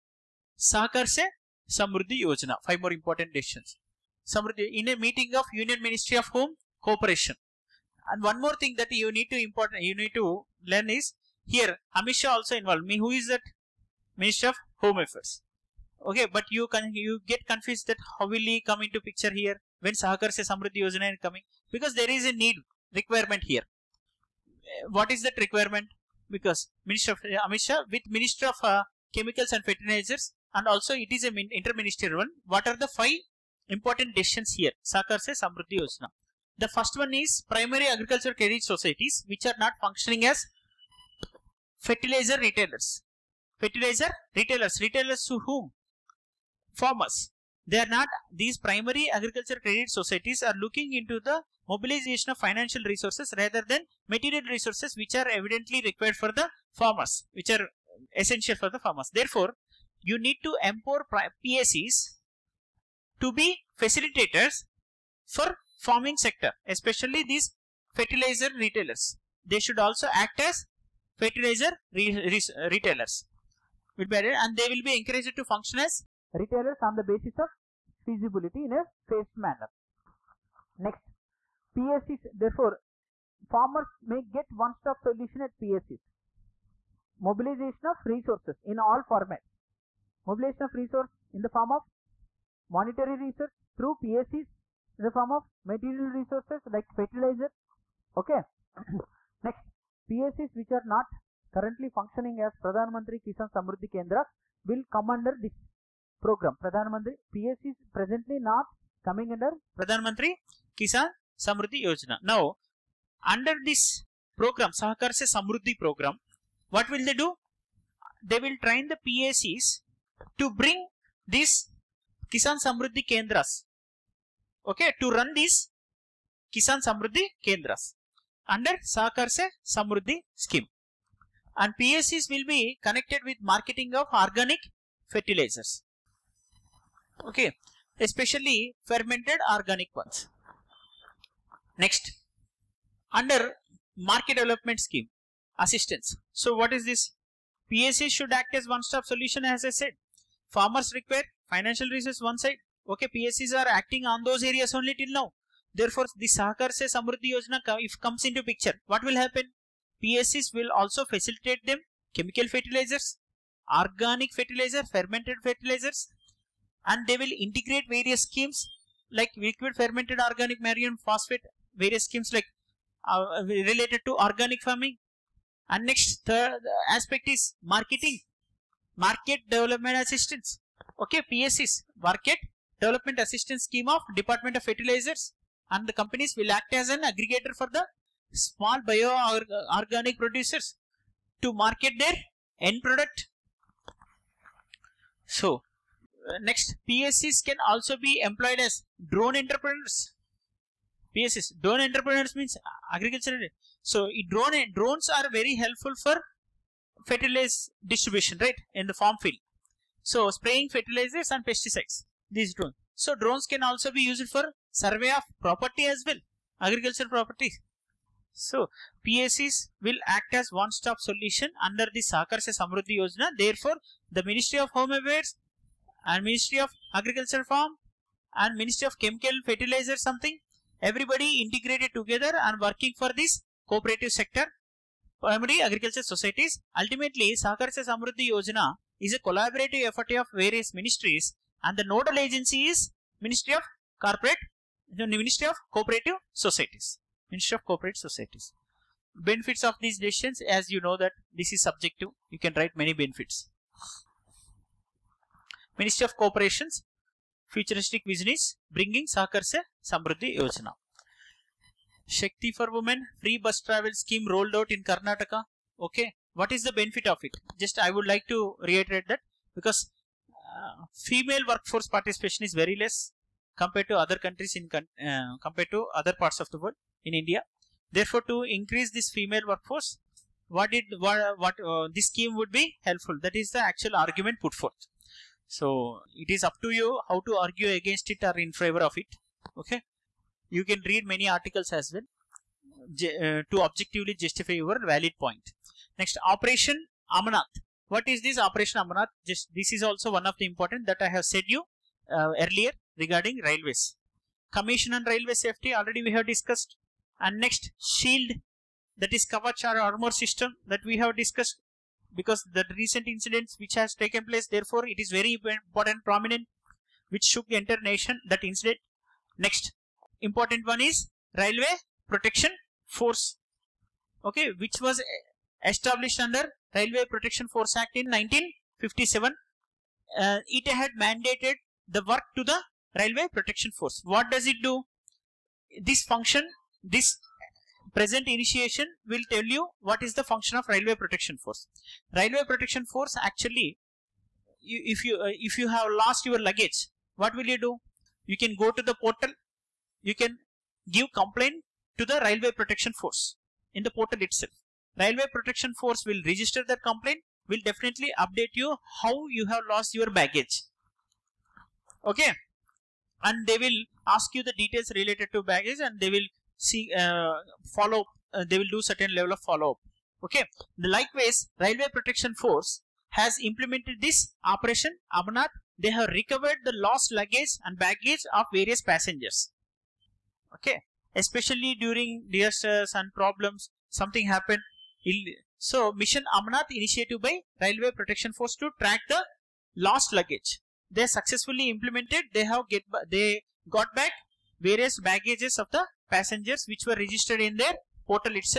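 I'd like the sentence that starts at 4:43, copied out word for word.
That is the actual argument put forth.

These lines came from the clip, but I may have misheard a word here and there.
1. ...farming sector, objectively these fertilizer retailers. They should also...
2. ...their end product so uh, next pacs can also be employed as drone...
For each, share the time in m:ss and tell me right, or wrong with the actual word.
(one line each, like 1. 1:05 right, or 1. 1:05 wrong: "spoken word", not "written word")
1. 1:05 wrong: "especially", not "objectively"
2. 3:11 right.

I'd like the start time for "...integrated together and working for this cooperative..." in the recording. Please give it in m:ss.
3:51.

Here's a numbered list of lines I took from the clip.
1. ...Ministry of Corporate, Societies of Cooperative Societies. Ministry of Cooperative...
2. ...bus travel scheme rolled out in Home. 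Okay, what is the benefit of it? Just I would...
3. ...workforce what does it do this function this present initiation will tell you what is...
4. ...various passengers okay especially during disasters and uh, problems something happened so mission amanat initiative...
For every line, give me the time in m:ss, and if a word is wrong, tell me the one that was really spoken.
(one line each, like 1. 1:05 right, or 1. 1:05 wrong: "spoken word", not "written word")
1. 4:03 wrong: "Ministry", not "Societies"
2. 4:23 wrong: "Karnataka", not "Home"
3. 5:33 wrong: "force", not "workforce"
4. 6:18 right.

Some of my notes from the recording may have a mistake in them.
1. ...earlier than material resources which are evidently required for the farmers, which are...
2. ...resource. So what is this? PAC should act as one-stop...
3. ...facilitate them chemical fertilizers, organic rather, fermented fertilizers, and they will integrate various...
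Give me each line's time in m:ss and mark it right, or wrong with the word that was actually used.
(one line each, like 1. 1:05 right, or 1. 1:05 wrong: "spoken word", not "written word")
1. 0:53 wrong: "rather", not "earlier"
2. 2:25 wrong: "assistance", not "resource"
3. 2:41 wrong: "fertilizer", not "rather".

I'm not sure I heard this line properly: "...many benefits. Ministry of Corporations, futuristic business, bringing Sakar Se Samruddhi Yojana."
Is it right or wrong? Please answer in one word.
right.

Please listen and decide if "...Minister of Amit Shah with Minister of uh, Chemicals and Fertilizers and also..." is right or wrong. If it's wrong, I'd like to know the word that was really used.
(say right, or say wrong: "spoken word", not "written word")
right.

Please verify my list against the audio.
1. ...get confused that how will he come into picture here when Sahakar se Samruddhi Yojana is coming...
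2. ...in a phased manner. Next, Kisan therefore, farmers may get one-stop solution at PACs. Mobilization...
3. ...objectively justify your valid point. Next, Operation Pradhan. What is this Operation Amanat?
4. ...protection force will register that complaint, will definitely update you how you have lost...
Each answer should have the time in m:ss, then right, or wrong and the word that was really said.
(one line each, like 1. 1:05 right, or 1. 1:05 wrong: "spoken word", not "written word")
1. 0:17 right
2. 1:18 wrong: "PACs", not "Kisan"
3. 4:53 wrong: "Amanat", not "Pradhan"
4. 5:55 right.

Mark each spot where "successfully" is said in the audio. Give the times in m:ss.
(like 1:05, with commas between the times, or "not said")
6:31.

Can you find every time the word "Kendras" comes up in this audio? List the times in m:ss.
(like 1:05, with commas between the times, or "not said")
1:43, 2:03, 2:07.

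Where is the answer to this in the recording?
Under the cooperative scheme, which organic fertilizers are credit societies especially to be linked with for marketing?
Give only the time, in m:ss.
2:18.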